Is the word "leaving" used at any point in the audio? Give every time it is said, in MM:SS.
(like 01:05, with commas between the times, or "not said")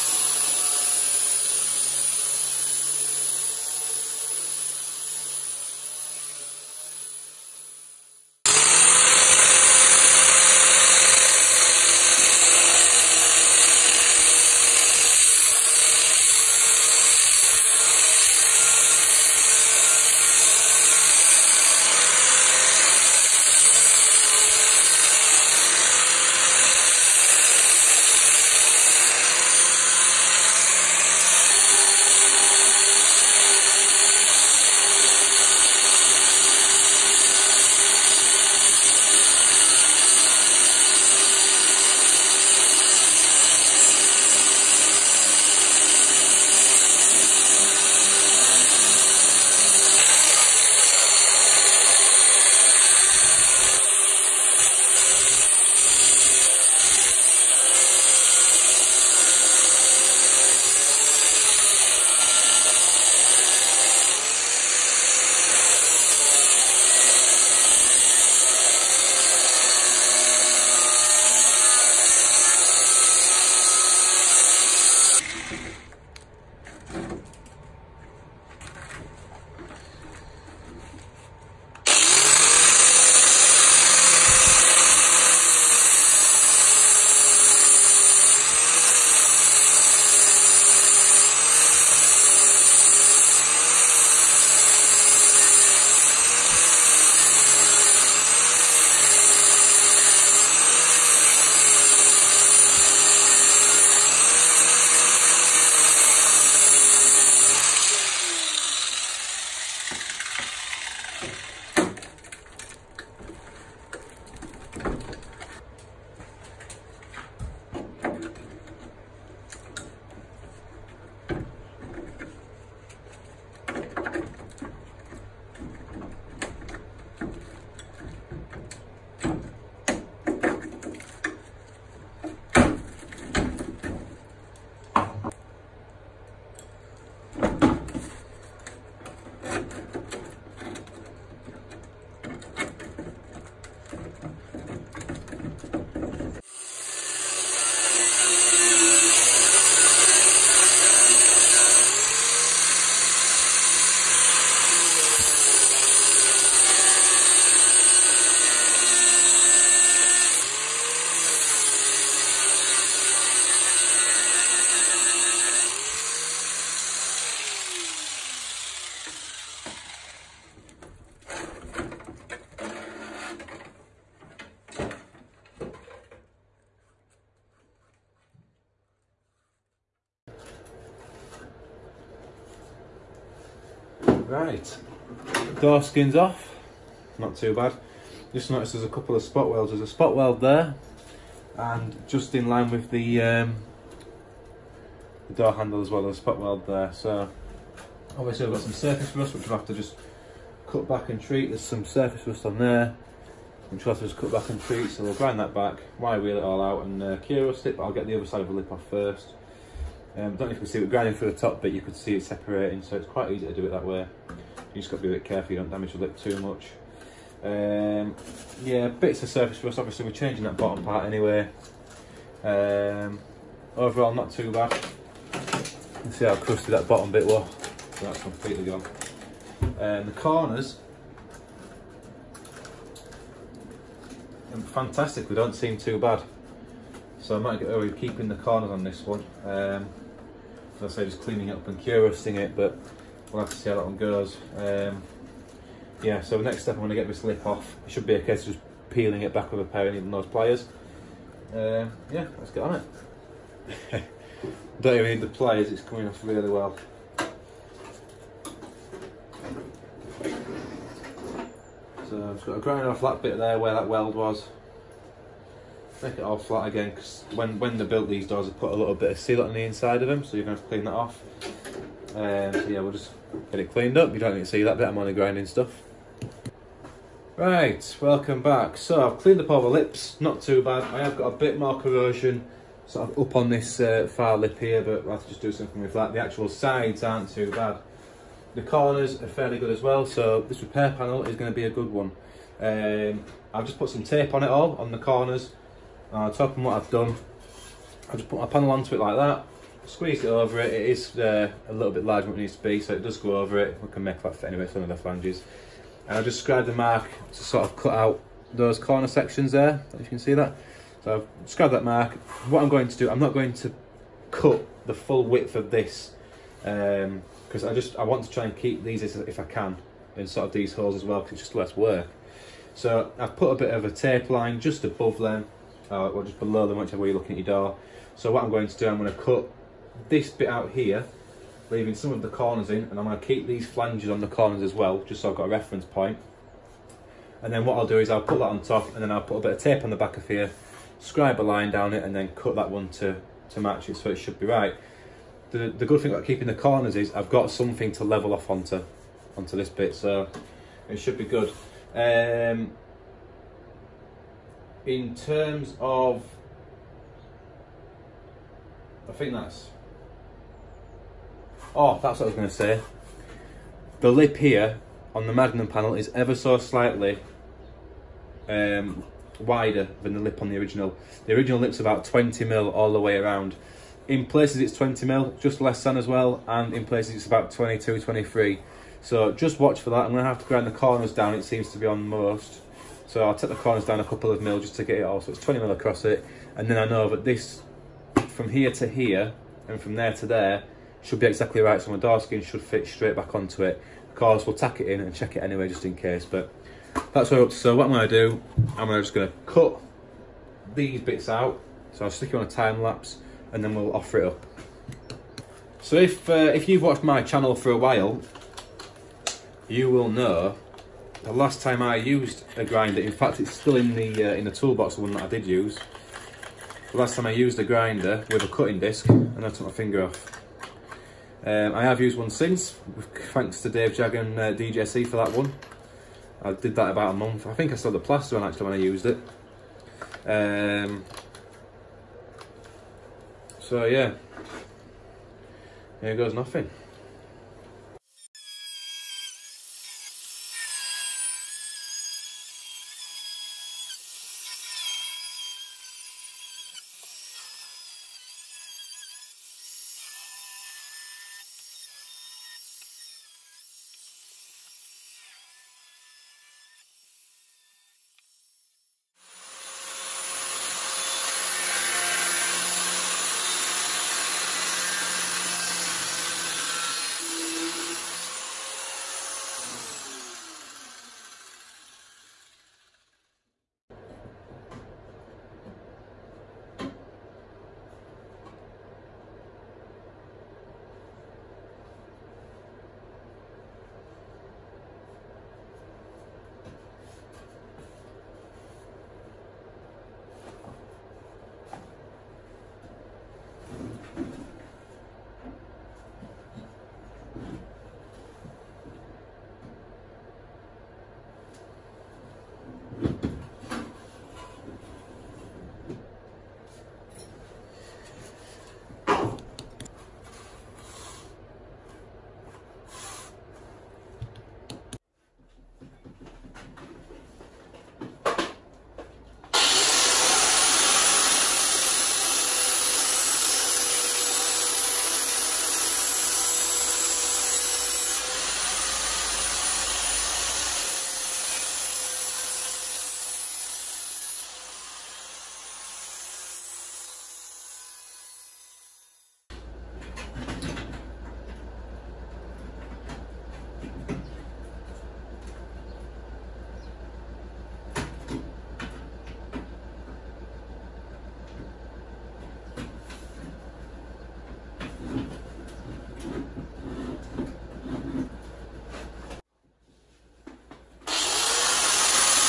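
05:31.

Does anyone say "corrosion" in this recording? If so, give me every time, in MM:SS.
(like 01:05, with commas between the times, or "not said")
04:41.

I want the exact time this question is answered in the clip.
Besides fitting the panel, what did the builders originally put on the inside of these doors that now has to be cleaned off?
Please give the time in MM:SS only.
04:29.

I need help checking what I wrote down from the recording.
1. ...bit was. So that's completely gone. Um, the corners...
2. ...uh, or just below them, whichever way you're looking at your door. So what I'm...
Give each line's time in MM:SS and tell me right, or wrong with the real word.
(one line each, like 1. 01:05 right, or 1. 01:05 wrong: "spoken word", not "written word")
1. 03:47 right
2. 05:25 right.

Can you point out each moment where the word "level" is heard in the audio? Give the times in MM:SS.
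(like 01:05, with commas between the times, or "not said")
05:48.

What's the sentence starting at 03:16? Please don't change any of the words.
So obviously I've got some surface rust, which I'll have to just cut back and treat.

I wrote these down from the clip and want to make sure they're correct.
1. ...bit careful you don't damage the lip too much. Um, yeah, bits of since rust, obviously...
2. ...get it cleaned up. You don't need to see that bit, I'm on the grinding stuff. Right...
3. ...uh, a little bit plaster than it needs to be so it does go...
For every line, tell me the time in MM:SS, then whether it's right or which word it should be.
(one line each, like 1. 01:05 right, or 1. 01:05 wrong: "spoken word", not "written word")
1. 03:35 wrong: "surface", not "since"
2. 04:33 right
3. 05:01 wrong: "larger", not "plaster".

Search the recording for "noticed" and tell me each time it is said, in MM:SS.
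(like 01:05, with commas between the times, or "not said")
03:08.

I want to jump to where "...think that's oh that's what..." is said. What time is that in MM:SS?
05:59.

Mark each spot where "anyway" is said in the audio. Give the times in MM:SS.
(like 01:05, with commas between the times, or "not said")
03:41, 05:04, 06:35.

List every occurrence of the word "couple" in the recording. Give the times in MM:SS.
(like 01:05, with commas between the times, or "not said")
03:08, 06:24.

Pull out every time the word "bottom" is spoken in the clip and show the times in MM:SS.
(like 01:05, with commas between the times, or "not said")
03:40, 03:46.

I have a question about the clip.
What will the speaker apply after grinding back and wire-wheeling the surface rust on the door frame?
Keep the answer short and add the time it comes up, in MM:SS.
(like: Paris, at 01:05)
Cure rust, at 03:27.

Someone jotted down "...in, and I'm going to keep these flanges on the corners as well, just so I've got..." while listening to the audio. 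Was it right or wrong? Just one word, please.
right.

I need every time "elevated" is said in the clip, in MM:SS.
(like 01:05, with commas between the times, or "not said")
not said.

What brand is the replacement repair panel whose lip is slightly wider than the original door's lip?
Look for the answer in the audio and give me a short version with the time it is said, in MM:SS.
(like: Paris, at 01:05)
Magnum, at 06:05.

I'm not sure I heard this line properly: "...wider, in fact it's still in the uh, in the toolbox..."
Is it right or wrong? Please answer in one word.
wrong.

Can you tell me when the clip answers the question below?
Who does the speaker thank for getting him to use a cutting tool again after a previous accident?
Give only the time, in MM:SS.
07:03.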